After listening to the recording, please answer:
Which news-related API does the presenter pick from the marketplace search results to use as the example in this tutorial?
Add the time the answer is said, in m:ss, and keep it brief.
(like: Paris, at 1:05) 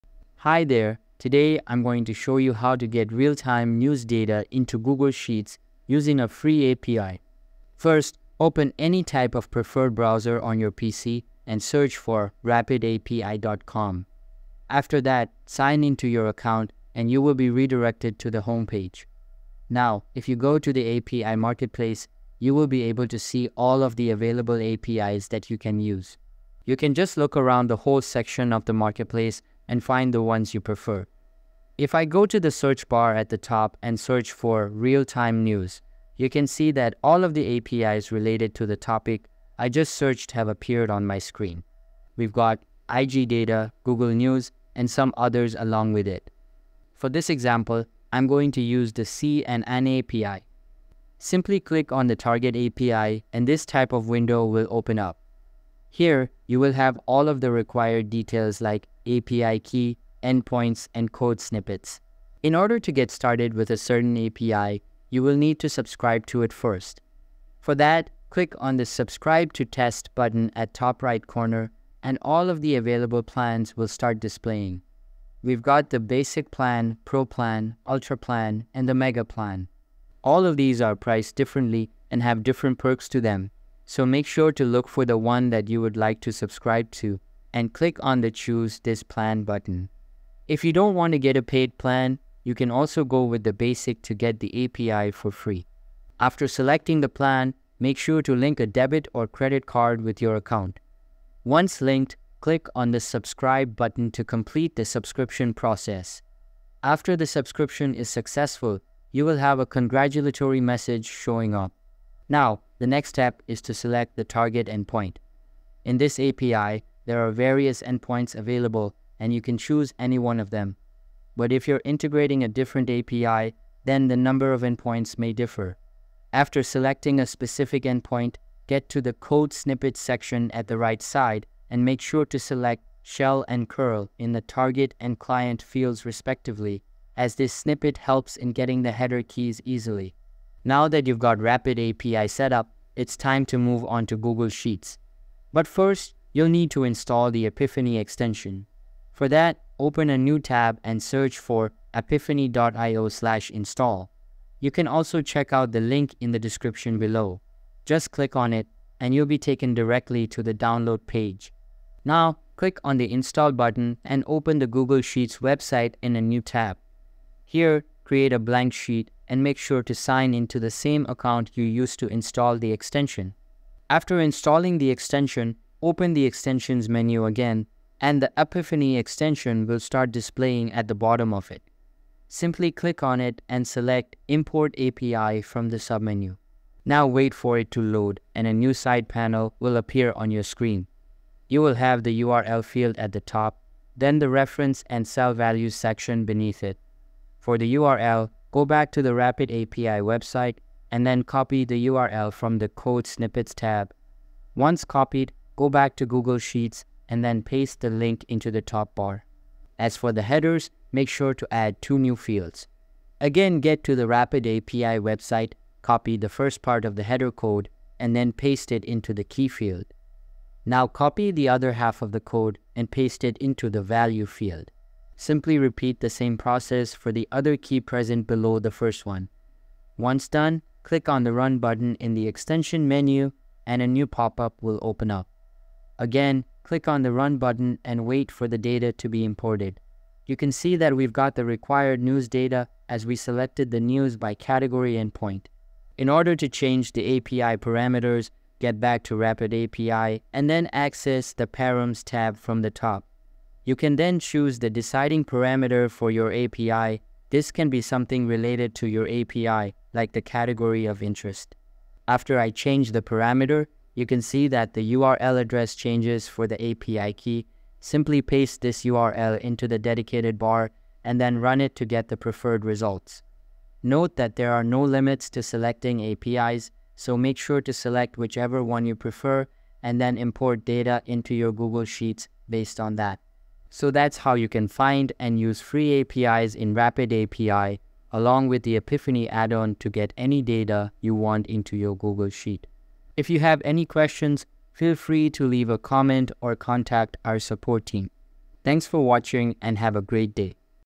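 C and N API, at 0:49.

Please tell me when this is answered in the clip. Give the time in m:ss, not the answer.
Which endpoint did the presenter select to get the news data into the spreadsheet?
4:03.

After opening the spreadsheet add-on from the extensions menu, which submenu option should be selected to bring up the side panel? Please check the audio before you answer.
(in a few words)
Import API.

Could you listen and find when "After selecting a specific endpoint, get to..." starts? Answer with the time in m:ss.
2:06.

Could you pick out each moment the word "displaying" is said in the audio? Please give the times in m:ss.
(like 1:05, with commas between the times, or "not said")
1:14, 3:00.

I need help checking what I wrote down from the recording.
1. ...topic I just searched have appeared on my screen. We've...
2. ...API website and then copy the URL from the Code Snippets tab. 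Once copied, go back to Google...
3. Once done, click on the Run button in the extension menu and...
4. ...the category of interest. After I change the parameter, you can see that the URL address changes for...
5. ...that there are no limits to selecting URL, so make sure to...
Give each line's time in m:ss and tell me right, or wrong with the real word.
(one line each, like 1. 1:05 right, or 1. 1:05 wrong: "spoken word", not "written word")
1. 0:38 right
2. 3:19 right
3. 3:49 right
4. 4:20 right
5. 4:34 wrong: "APIs", not "URL".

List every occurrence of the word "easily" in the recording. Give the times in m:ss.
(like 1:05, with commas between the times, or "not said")
2:19.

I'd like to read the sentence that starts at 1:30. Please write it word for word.
If you don't want to get a paid plan, you can also go with the basic to get the API for free.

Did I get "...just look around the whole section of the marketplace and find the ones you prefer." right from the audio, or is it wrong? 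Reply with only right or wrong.
right.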